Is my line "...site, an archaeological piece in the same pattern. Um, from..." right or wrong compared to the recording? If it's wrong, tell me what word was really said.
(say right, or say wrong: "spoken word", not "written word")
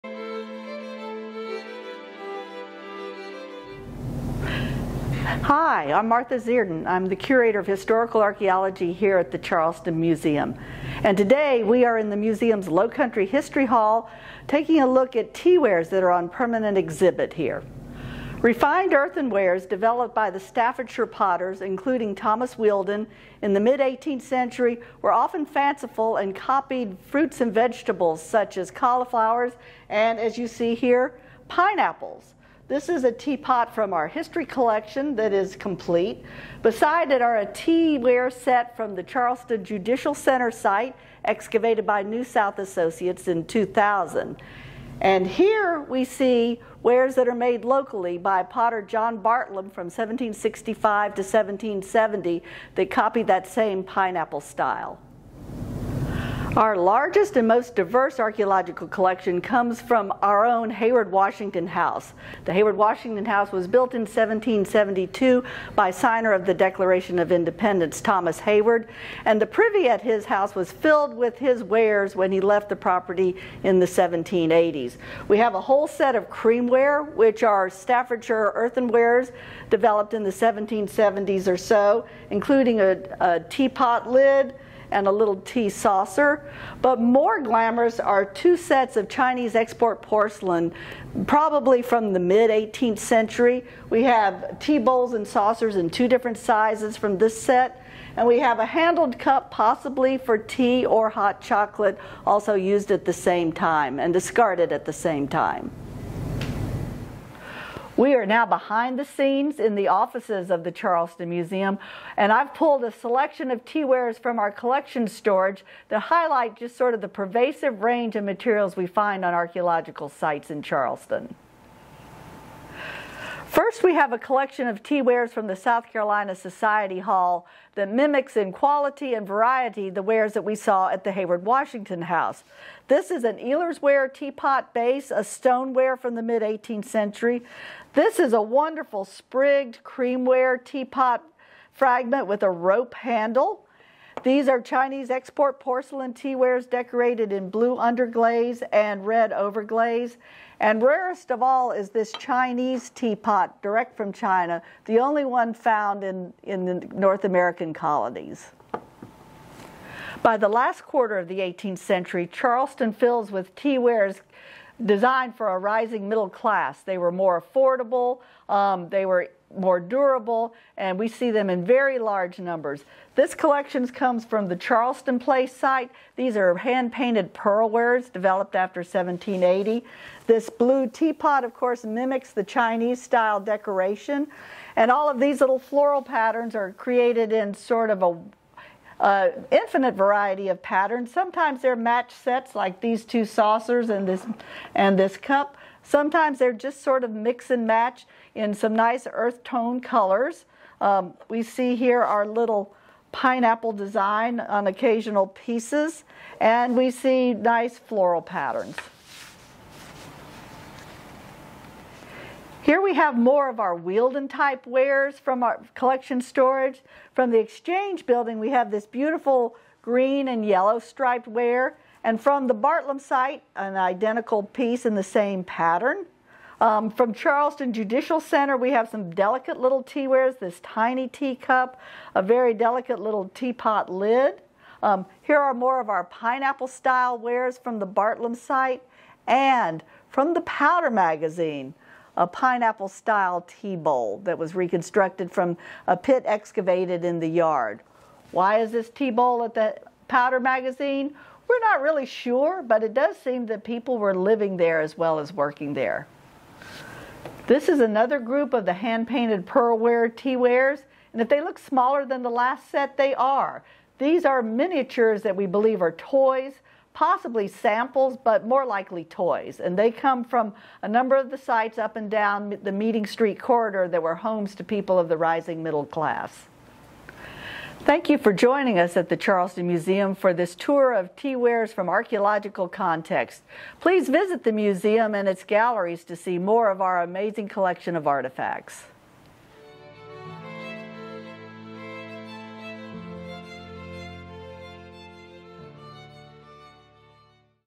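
wrong: "identical", not "archaeological".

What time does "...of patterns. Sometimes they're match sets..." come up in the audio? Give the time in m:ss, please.
3:10.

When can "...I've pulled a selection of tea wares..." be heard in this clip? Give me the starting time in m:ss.
1:52.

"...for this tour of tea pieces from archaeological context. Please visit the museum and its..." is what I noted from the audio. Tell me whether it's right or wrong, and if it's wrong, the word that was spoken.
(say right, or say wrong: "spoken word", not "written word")
wrong: "wares", not "pieces".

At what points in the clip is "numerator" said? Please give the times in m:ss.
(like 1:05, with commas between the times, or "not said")
not said.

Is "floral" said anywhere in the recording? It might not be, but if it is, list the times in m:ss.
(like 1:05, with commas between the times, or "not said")
3:05, 3:27.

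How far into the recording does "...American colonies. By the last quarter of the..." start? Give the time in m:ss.
2:37.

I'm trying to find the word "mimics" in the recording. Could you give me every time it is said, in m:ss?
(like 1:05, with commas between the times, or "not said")
2:07, 3:01.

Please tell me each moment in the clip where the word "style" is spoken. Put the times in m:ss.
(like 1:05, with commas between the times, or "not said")
0:54, 3:03, 3:56, 4:02.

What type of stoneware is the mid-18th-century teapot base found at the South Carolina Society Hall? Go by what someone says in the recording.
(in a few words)
Elers ware.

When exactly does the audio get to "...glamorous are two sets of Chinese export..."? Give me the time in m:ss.
1:27.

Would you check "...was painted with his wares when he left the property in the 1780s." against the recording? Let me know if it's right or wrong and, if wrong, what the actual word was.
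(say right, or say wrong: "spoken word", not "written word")
wrong: "filled", not "painted".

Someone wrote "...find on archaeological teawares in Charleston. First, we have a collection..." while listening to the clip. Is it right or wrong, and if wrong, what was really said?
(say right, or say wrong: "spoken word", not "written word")
wrong: "sites", not "teawares".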